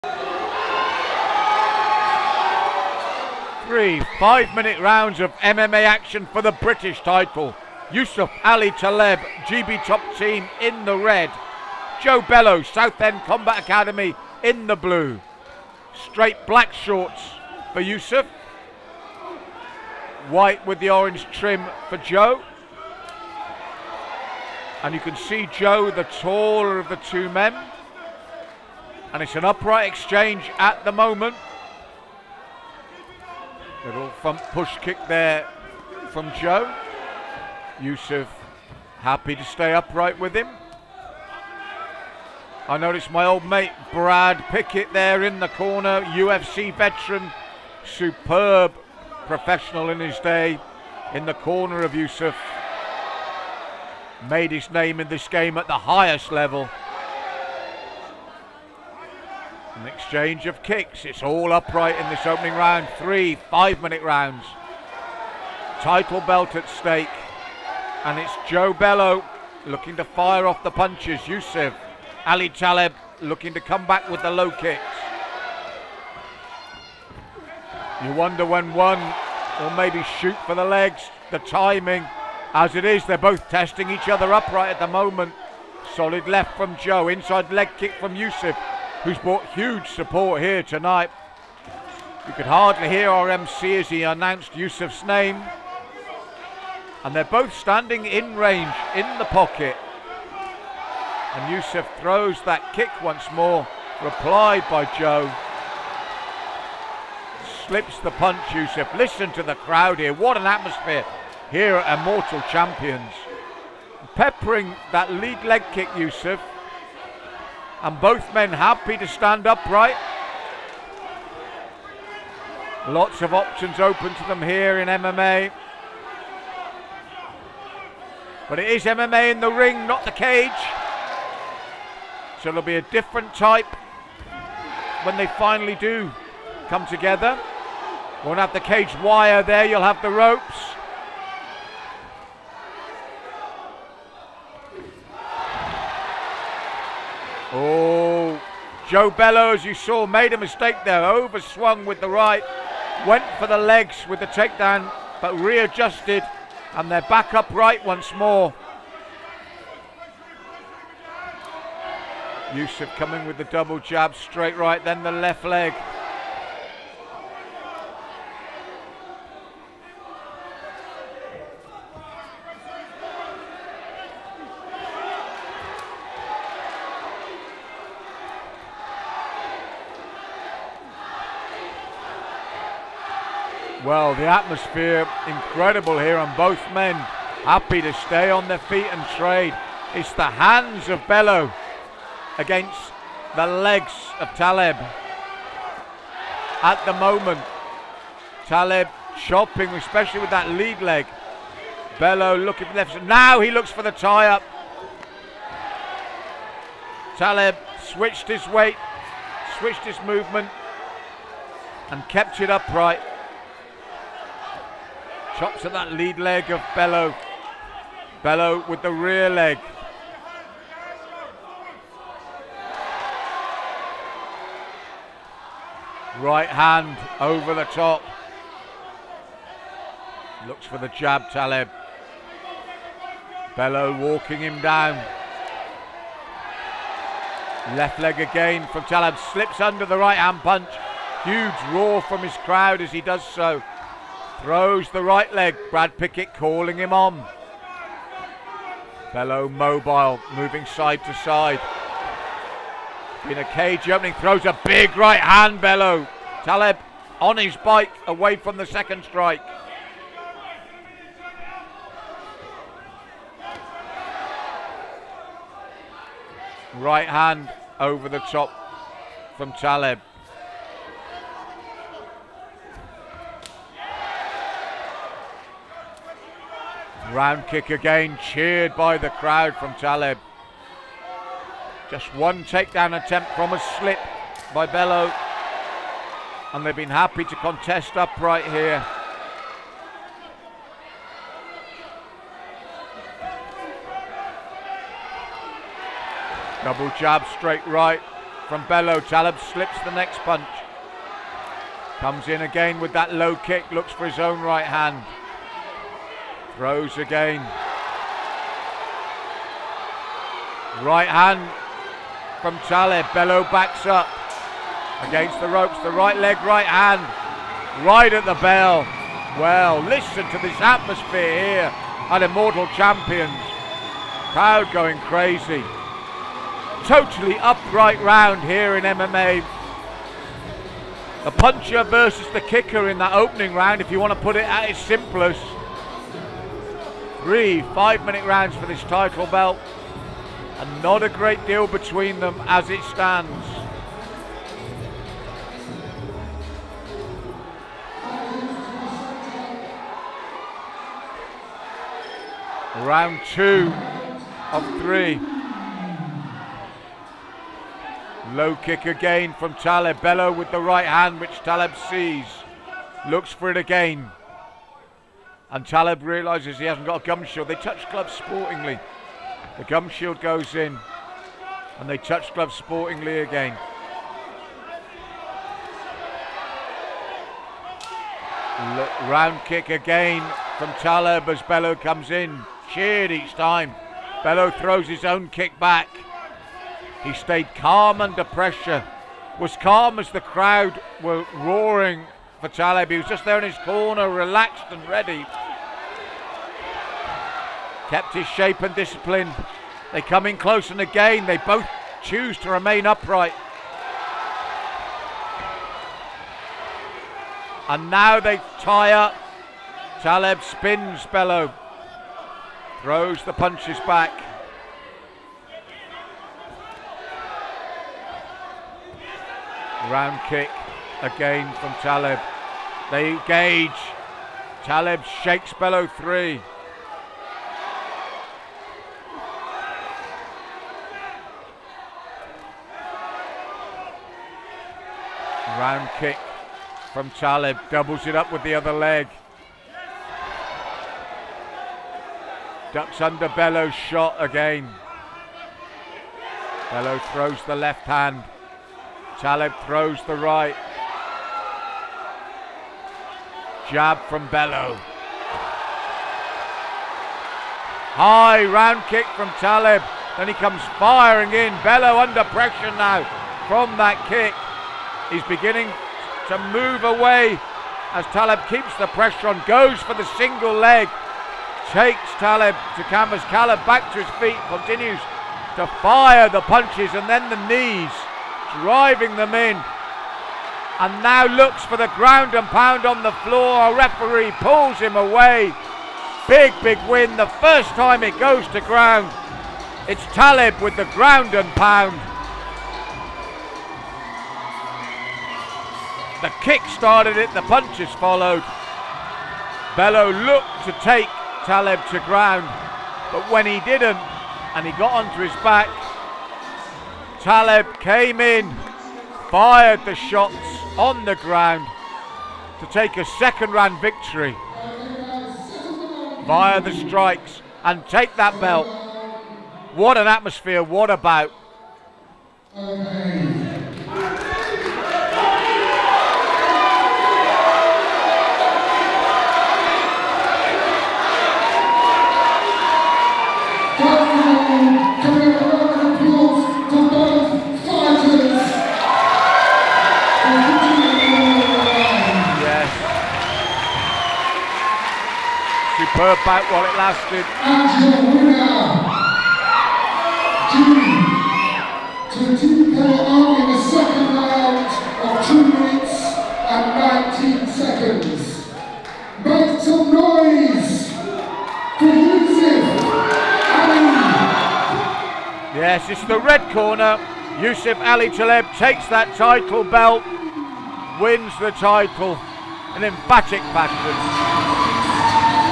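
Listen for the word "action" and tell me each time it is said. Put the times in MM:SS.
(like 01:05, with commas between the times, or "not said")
00:05.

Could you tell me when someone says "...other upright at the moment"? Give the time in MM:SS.
01:24.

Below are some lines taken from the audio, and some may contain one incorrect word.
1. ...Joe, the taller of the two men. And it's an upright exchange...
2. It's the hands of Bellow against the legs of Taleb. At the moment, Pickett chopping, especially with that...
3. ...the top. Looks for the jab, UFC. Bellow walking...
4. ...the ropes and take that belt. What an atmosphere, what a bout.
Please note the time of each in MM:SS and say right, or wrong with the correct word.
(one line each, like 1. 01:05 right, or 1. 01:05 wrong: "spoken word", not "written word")
1. 00:25 right
2. 03:09 wrong: "Taleb", not "Pickett"
3. 03:47 wrong: "Taleb", not "UFC"
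4. 08:36 wrong: "strikes", not "ropes".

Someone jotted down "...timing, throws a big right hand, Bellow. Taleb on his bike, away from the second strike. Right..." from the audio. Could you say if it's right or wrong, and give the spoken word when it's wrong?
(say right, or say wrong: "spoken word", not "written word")
wrong: "opening", not "timing".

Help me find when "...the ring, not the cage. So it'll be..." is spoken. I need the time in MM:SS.
02:09.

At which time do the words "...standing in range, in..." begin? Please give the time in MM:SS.
01:37.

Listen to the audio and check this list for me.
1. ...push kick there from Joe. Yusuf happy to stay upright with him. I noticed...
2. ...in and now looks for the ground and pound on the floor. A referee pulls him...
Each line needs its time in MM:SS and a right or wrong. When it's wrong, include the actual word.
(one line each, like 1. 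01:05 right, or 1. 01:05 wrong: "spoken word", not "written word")
1. 00:34 right
2. 07:59 right.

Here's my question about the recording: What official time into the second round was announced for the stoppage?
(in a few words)
2 minutes 19 seconds.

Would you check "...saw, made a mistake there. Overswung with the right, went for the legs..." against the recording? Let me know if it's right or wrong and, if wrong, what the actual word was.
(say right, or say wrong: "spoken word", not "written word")
right.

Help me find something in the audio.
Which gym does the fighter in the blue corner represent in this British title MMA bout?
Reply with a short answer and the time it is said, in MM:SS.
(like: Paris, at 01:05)
Southend Combat Academy, at 00:12.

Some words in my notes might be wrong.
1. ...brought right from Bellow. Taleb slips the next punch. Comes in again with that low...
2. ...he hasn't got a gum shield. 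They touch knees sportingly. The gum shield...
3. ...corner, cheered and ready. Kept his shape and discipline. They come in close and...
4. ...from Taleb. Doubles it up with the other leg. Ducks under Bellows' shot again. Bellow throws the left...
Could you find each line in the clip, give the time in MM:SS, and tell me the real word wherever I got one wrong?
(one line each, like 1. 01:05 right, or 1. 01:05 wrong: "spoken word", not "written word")
1. 04:57 wrong: "straight", not "brought"
2. 06:06 wrong: "gloves", not "knees"
3. 06:33 wrong: "relaxed", not "cheered"
4. 07:16 right.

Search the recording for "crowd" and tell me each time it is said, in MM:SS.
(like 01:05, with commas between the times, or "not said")
01:49, 04:02, 04:39, 05:24, 06:30.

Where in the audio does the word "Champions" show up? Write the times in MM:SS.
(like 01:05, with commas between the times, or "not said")
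01:52, 05:22.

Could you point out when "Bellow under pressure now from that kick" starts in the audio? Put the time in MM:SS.
07:41.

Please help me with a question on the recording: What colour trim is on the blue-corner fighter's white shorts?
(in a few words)
Orange.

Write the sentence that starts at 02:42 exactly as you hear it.
Yusuf coming with the double jab, straight right, then the left leg.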